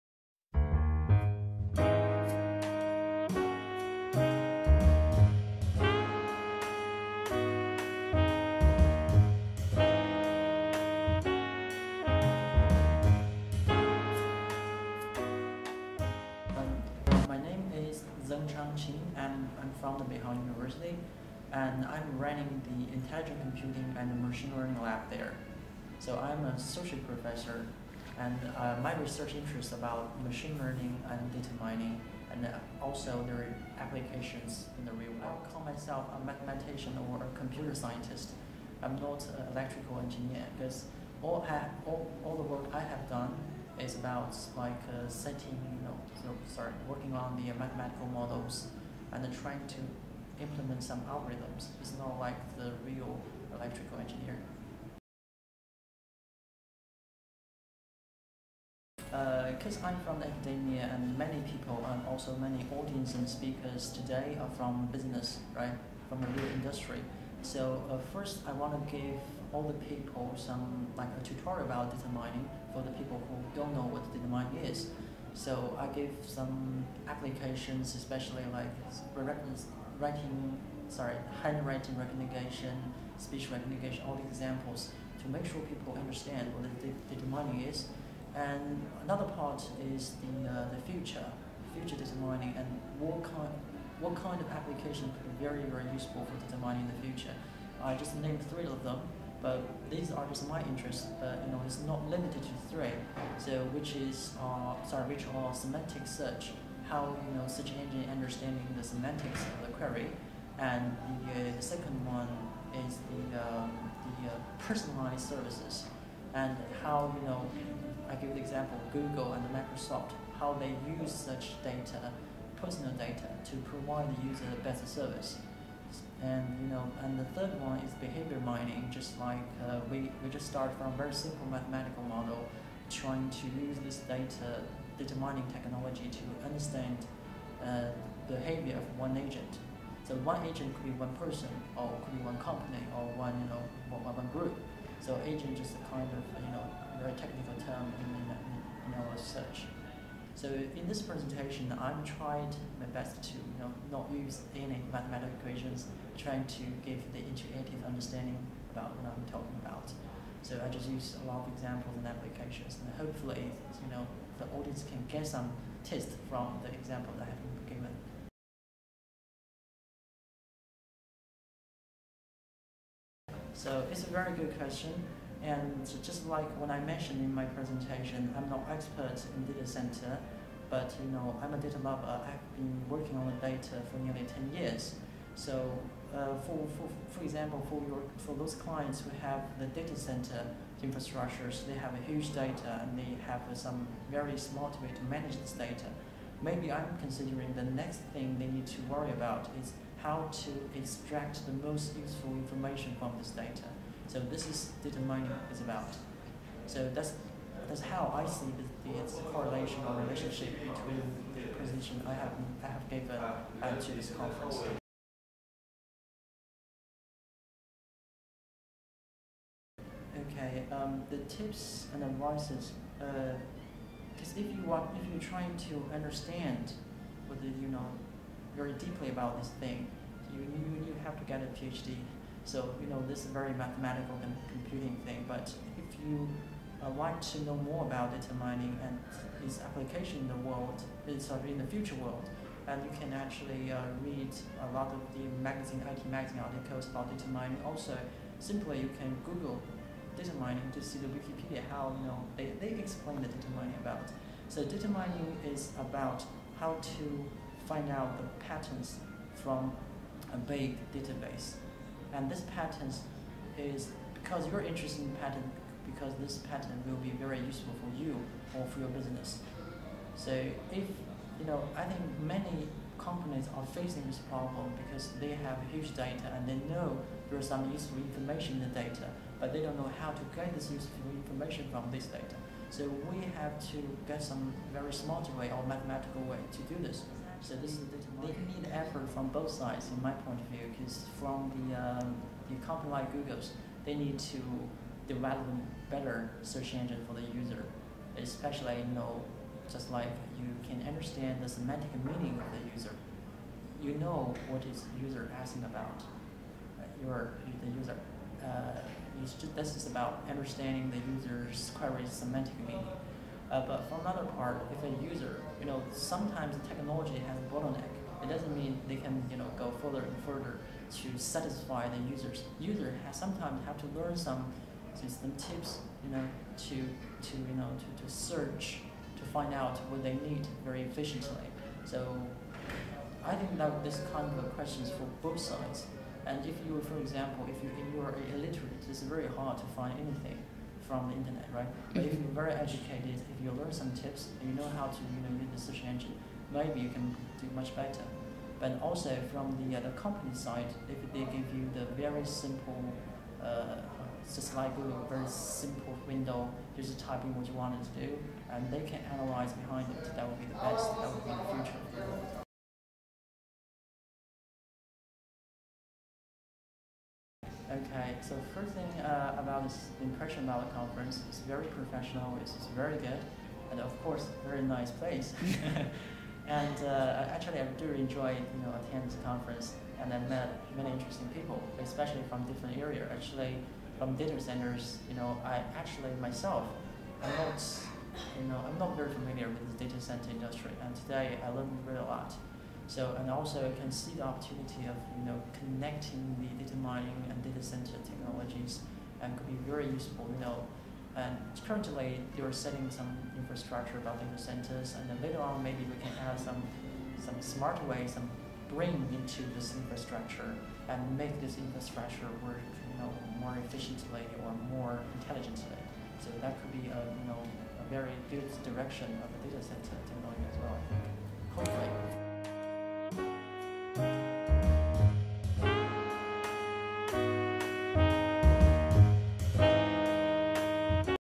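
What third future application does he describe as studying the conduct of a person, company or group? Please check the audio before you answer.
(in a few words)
Behavior mining.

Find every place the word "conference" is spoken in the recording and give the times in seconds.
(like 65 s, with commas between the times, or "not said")
214 s, 370 s, 379 s.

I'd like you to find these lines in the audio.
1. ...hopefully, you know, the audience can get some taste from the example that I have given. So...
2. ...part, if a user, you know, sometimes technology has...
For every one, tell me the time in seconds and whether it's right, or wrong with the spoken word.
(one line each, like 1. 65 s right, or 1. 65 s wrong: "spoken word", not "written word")
1. 162 s right
2. 314 s right.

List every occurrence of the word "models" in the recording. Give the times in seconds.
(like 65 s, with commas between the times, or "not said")
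48 s, 132 s.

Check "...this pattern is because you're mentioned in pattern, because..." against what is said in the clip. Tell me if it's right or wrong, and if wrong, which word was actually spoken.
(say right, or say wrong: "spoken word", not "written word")
wrong: "interested", not "mentioned".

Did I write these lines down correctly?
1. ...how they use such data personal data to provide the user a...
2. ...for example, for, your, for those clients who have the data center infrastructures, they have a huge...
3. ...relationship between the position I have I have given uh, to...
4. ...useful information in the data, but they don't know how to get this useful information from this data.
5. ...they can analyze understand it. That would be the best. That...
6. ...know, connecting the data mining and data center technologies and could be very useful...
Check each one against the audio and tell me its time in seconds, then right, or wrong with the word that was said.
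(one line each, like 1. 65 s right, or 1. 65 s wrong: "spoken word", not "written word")
1. 120 s right
2. 187 s right
3. 210 s right
4. 277 s right
5. 358 s wrong: "behind", not "understand"
6. 395 s right.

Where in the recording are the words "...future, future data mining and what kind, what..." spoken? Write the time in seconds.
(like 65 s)
90 s.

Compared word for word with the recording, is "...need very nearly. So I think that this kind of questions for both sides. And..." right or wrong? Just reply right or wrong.
wrong.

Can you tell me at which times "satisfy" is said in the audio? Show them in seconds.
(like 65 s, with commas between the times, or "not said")
321 s.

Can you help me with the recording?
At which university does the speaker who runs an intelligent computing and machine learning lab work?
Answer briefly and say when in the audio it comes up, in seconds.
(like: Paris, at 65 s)
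Beihang University, at 20 s.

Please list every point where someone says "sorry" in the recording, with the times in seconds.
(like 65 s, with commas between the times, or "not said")
46 s, 80 s, 104 s.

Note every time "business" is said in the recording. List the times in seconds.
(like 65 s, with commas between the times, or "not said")
64 s, 268 s.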